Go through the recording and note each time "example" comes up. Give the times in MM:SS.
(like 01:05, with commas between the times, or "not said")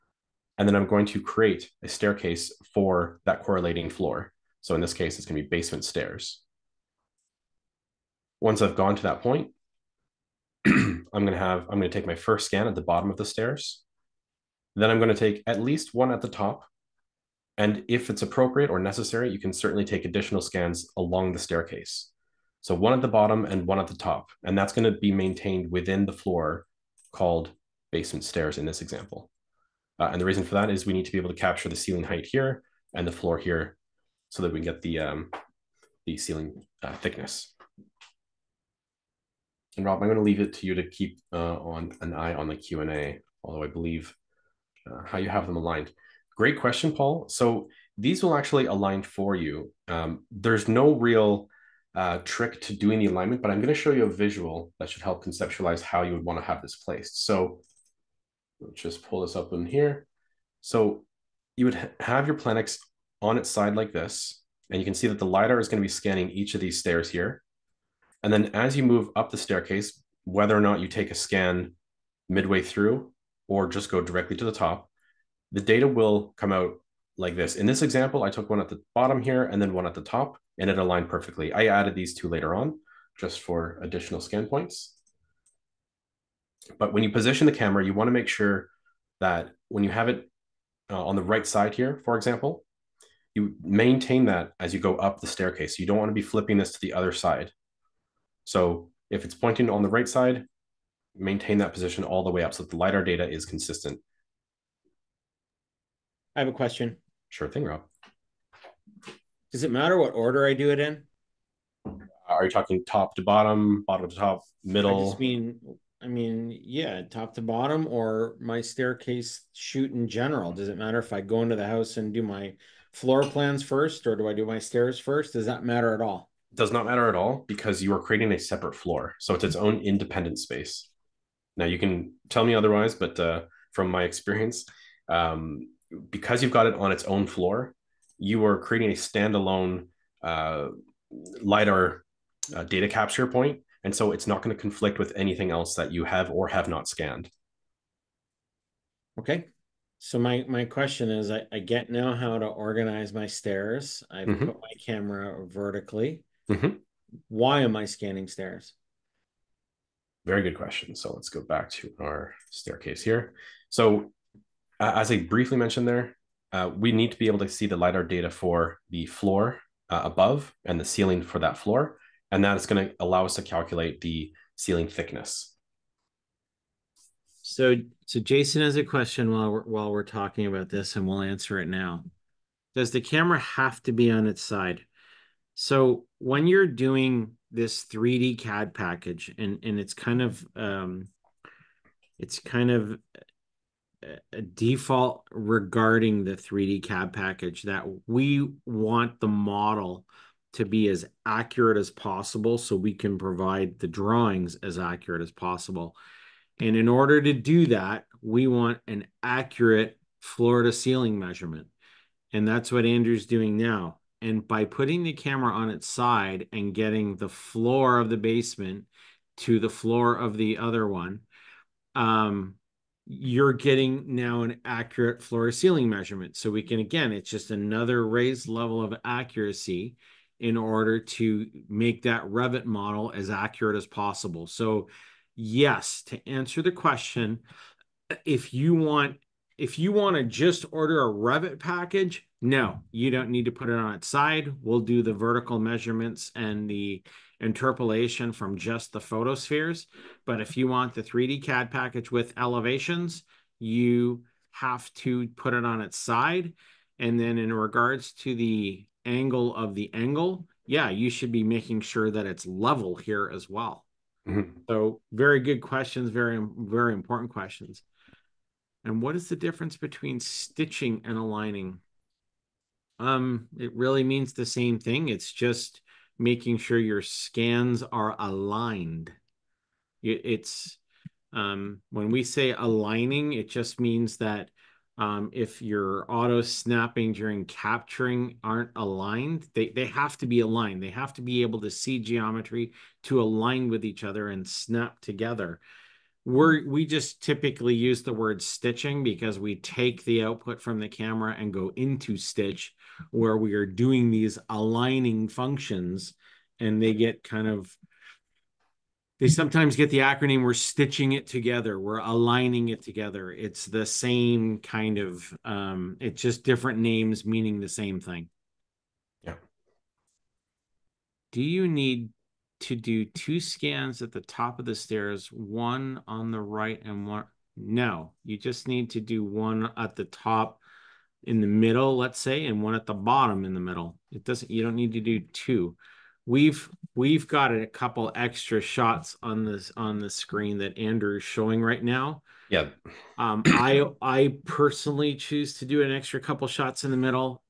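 00:28, 01:17, 01:32.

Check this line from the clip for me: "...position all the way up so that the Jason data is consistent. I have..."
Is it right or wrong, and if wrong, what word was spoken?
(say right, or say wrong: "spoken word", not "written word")
wrong: "LiDAR", not "Jason".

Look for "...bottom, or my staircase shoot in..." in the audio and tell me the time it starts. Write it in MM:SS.
01:57.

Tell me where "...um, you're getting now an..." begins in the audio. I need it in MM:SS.
03:41.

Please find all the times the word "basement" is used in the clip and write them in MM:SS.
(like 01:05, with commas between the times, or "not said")
00:05, 00:27, 03:38.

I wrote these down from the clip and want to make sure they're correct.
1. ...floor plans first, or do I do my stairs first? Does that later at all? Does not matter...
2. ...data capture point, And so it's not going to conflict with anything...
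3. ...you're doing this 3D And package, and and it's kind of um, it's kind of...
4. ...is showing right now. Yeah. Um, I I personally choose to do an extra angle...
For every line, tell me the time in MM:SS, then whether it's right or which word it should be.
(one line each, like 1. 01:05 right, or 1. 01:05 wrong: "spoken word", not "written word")
1. 02:02 wrong: "matter", not "later"
2. 02:22 right
3. 03:06 wrong: "CAD", not "And"
4. 05:41 wrong: "couple", not "angle".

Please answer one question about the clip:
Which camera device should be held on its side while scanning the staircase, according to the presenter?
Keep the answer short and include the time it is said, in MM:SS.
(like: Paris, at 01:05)
Planix, at 01:02.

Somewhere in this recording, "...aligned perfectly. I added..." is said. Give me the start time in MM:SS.
01:20.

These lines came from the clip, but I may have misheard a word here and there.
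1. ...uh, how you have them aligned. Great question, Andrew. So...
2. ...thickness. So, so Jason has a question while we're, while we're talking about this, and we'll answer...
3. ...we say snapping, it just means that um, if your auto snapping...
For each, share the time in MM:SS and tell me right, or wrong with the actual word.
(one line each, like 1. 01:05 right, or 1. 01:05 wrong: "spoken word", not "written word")
1. 00:44 wrong: "Paul", not "Andrew"
2. 02:54 right
3. 04:42 wrong: "aligning", not "snapping".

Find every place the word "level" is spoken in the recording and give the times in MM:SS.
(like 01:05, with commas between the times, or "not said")
03:48, 04:22.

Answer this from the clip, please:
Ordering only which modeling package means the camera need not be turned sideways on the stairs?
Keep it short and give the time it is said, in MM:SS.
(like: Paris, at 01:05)
Revit package, at 04:01.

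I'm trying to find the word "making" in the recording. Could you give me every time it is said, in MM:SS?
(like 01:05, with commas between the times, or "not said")
04:21, 04:36.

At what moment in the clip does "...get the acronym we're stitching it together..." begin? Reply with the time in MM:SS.
05:09.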